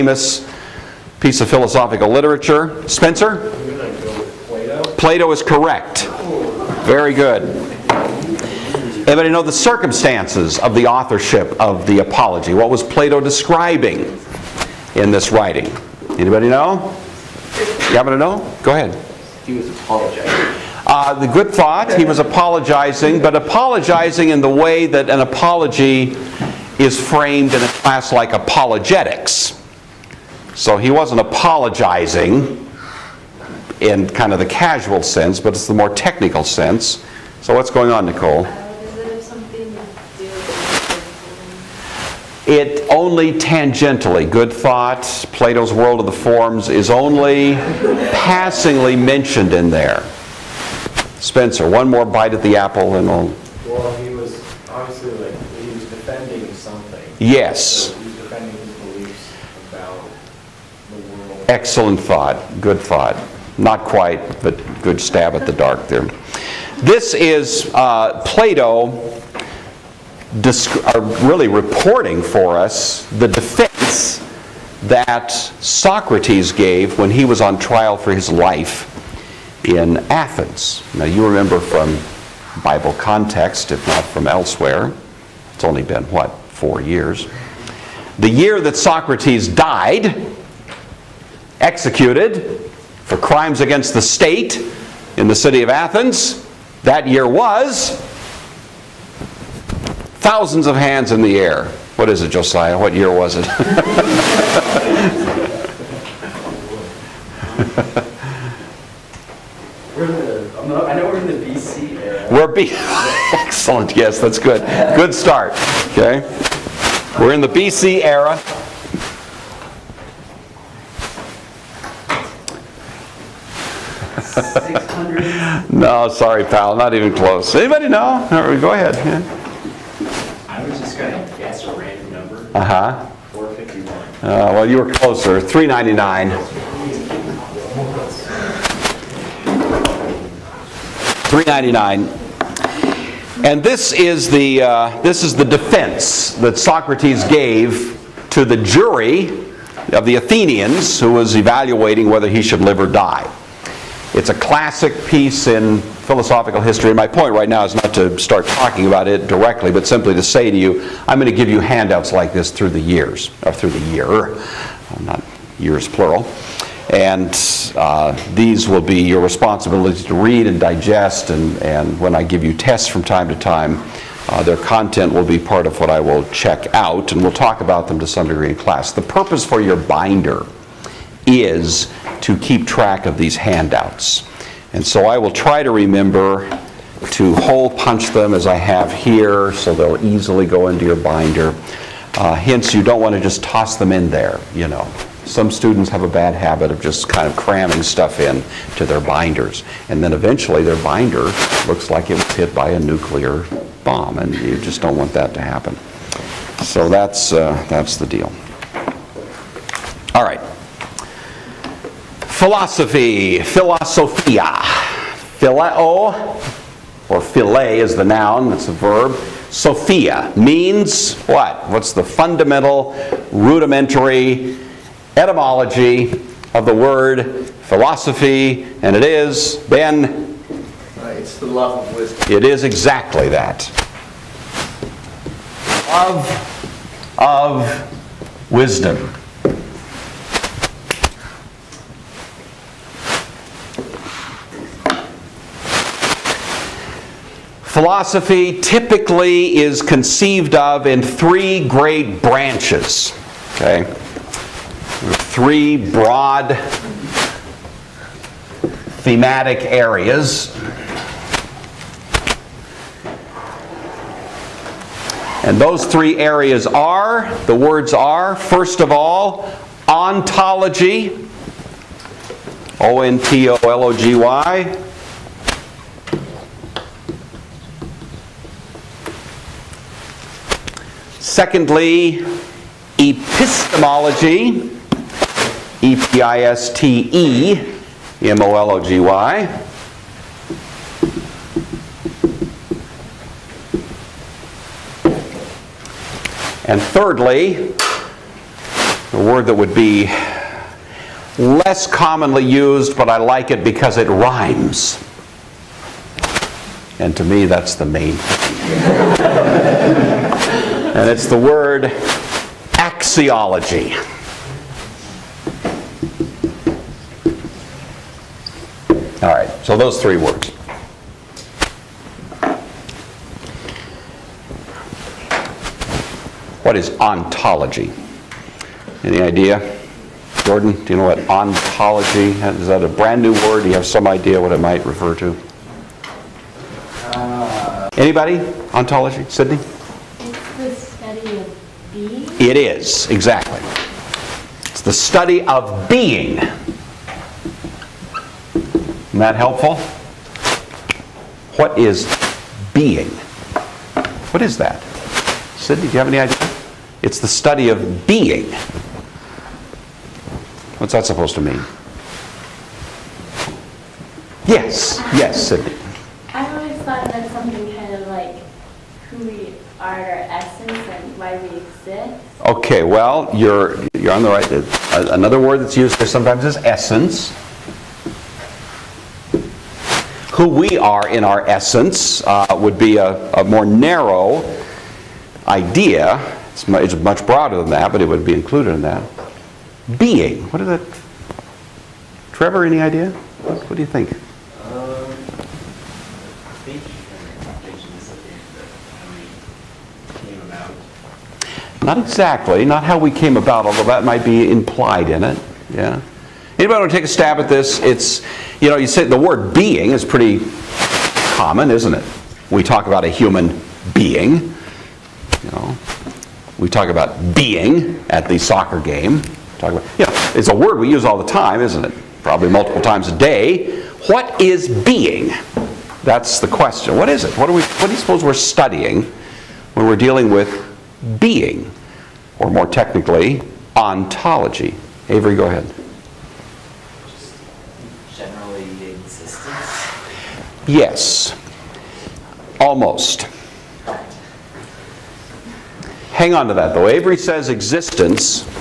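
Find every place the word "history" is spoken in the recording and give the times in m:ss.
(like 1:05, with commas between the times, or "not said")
2:36.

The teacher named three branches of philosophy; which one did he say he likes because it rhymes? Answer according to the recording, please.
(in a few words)
axiology.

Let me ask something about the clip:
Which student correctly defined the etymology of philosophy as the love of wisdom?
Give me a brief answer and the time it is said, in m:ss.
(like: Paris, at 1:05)
Ben, at 3:49.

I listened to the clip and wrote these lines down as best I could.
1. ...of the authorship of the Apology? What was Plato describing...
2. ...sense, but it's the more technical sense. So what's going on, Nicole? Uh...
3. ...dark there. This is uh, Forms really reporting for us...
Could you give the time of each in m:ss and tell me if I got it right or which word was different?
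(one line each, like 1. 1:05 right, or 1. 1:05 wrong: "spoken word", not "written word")
1. 0:10 right
2. 0:35 right
3. 1:05 wrong: "Plato", not "Forms".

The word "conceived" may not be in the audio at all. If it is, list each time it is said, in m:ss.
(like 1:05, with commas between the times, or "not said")
4:09.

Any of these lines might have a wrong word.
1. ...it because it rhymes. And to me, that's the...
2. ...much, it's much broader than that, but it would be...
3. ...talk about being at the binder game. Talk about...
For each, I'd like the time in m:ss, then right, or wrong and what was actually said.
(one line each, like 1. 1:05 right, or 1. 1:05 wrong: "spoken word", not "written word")
1. 5:03 right
2. 6:26 right
3. 6:56 wrong: "soccer", not "binder".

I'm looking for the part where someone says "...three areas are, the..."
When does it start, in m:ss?
4:25.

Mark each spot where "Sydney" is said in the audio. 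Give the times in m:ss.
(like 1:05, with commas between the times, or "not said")
5:39, 5:55, 6:05.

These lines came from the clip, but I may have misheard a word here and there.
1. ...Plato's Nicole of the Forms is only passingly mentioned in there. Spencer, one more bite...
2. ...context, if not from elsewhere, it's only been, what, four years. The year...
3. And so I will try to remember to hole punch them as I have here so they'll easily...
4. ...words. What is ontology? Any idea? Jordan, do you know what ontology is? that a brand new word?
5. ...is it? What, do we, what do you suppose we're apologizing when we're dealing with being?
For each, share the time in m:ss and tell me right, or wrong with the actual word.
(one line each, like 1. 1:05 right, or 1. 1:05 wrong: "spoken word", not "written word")
1. 0:45 wrong: "World", not "Nicole"
2. 1:22 right
3. 3:04 right
4. 5:20 right
5. 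7:07 wrong: "studying", not "apologizing".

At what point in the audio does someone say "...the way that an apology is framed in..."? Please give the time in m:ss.
0:24.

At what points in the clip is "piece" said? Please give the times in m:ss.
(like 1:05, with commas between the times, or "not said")
0:01, 2:35.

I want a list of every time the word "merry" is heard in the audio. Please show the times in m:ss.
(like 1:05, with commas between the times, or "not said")
not said.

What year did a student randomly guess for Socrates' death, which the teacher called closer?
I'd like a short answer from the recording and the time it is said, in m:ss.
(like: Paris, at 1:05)
451, at 2:13.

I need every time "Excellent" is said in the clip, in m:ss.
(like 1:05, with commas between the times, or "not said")
1:01, 1:53.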